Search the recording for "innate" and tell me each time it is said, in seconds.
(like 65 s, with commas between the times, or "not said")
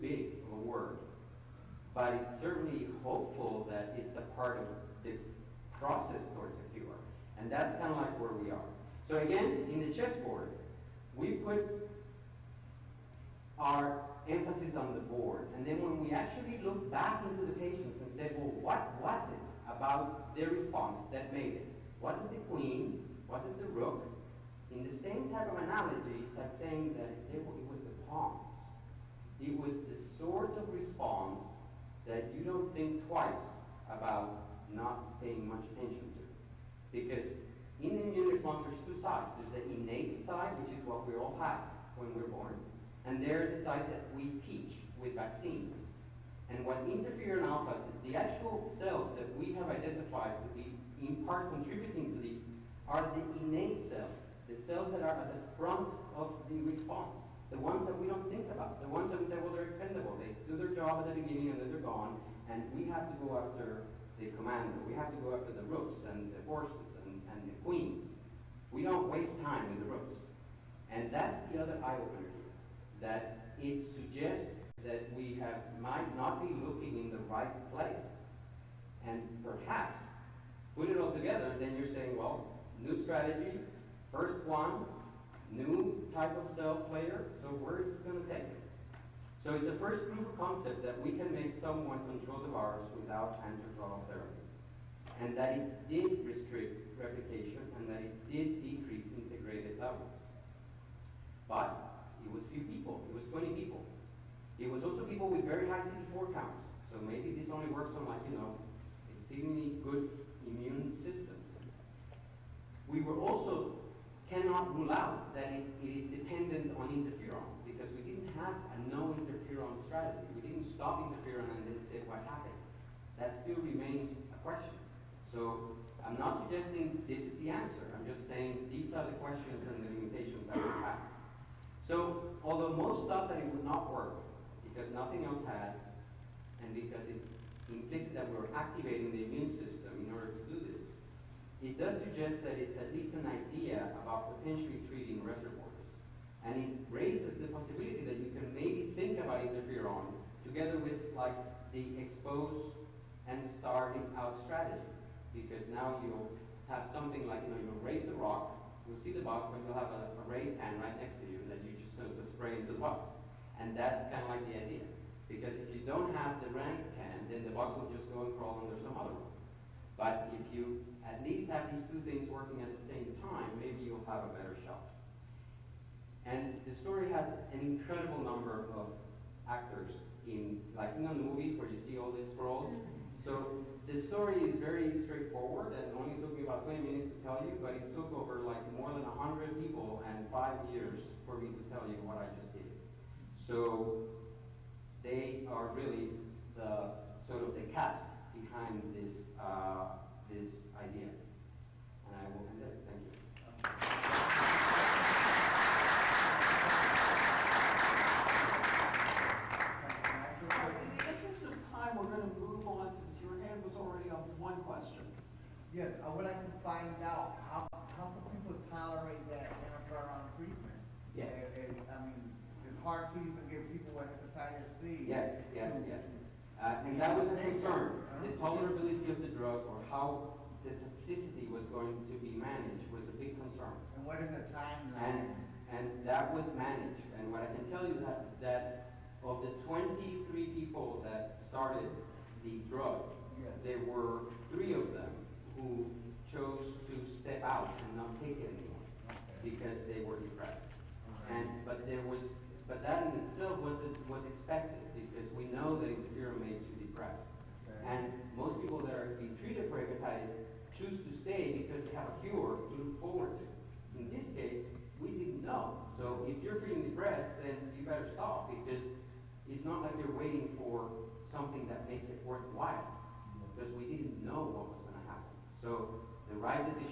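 39 s, 53 s.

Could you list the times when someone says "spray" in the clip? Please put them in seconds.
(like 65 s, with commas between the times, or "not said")
162 s.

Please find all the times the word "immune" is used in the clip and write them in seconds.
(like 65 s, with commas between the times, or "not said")
38 s, 110 s, 139 s.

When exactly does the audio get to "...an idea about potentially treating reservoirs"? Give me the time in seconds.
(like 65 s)
143 s.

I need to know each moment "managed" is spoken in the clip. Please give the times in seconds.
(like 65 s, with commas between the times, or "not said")
232 s, 236 s.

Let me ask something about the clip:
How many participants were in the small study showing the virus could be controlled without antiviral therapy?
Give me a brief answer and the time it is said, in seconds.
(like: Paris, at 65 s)
20, at 103 s.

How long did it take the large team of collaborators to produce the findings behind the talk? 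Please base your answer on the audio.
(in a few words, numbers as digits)
5 years.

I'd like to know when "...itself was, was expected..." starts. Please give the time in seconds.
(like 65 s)
253 s.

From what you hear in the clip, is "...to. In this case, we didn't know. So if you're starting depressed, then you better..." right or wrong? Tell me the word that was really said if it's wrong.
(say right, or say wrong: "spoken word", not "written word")
wrong: "feeling", not "starting".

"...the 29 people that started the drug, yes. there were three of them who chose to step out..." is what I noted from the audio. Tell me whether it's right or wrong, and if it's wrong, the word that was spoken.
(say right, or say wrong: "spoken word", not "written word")
wrong: "23", not "29".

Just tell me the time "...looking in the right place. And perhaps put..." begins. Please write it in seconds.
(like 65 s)
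76 s.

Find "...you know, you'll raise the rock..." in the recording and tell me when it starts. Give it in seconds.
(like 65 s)
157 s.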